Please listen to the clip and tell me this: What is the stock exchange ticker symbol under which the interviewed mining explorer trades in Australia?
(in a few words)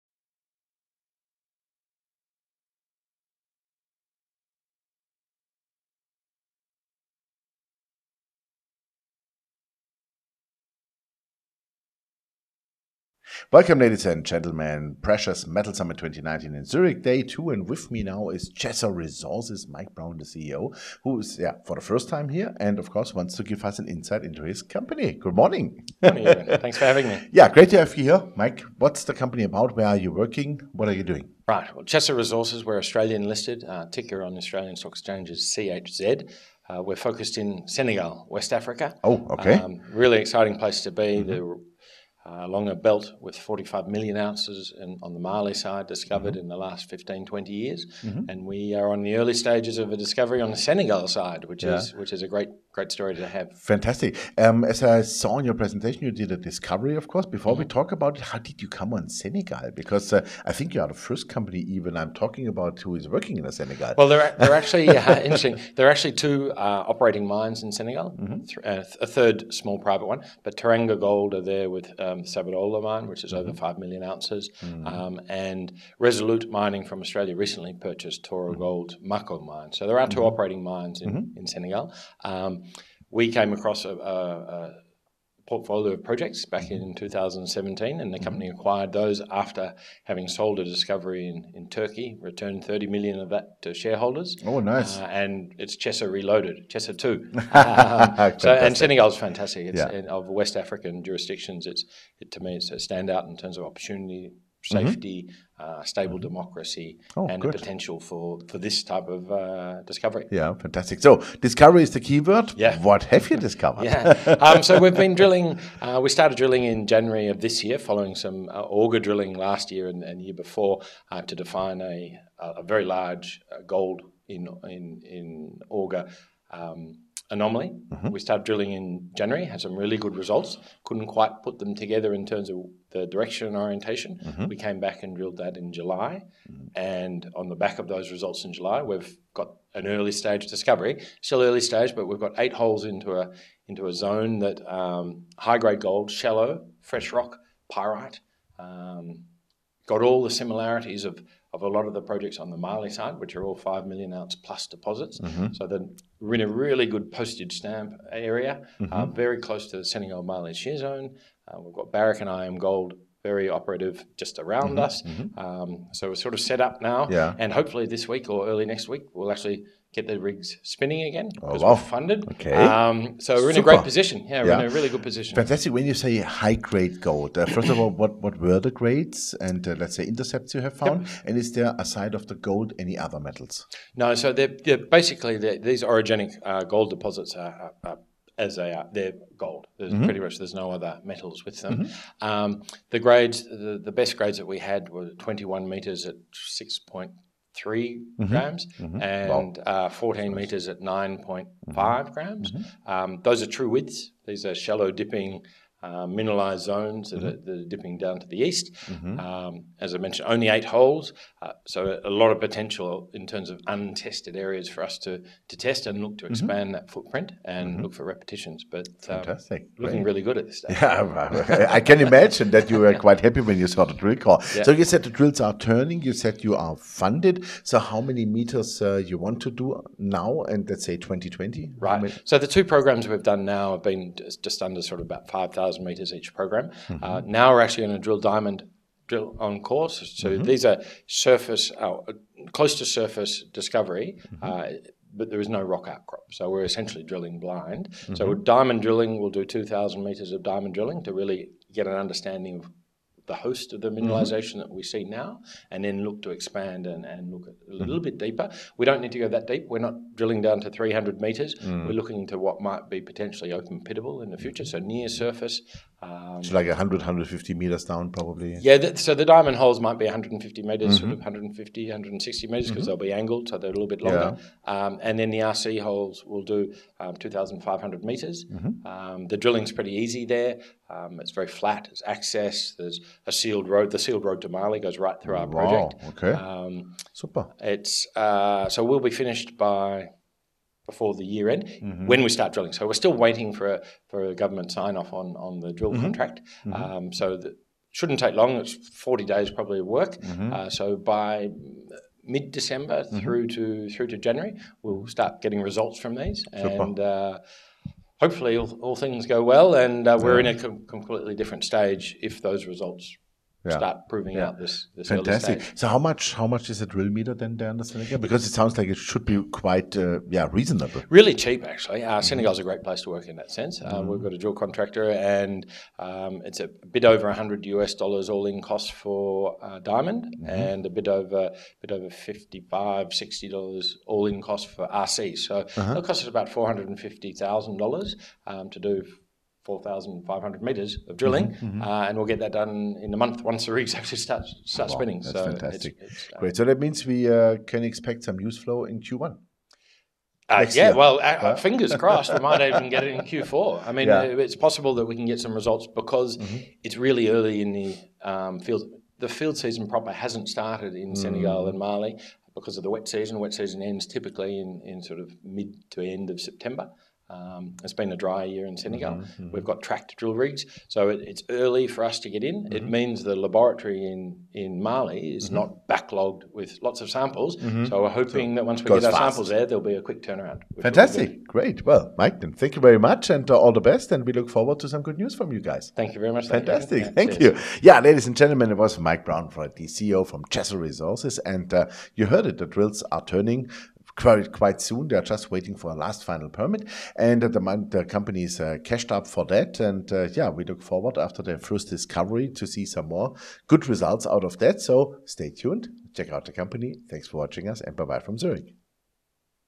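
CHZ.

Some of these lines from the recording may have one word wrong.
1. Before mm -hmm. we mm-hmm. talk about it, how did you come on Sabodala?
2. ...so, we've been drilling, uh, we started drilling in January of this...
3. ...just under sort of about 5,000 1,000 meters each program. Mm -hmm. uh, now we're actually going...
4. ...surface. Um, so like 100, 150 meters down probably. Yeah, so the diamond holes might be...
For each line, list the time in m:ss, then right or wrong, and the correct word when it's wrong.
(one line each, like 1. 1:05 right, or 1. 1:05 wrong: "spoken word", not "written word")
1. 0:57 wrong: "Senegal", not "Sabodala"
2. 1:54 right
3. 3:54 right
4. 4:25 right.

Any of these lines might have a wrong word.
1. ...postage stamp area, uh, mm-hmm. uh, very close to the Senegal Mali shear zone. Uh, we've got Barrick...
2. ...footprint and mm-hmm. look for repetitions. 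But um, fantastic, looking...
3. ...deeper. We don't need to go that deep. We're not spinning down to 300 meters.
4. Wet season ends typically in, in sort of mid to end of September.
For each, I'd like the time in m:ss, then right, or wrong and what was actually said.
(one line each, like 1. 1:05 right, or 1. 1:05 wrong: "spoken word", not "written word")
1. 2:37 right
2. 3:36 right
3. 4:18 wrong: "drilling", not "spinning"
4. 6:03 right.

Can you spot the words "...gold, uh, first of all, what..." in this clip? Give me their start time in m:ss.
2:57.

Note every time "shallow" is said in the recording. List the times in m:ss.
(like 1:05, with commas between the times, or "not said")
2:26, 3:24.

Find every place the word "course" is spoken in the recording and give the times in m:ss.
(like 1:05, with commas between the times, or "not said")
0:22, 0:57, 3:59.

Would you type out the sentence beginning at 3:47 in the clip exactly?
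So how many meters uh, you want to do now, and let's say 2020?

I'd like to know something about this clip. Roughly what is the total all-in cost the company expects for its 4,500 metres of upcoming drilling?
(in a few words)
450 thousand dollars.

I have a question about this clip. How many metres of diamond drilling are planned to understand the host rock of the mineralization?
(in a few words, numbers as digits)
2,000 metres.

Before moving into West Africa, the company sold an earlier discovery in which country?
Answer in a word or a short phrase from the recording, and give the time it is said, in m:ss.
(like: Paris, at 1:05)
Turkey, at 1:31.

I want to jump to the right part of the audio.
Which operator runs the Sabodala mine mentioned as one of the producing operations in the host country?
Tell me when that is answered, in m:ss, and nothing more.
1:10.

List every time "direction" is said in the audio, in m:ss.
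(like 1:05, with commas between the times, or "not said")
2:13.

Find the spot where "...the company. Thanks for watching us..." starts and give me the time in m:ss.
6:46.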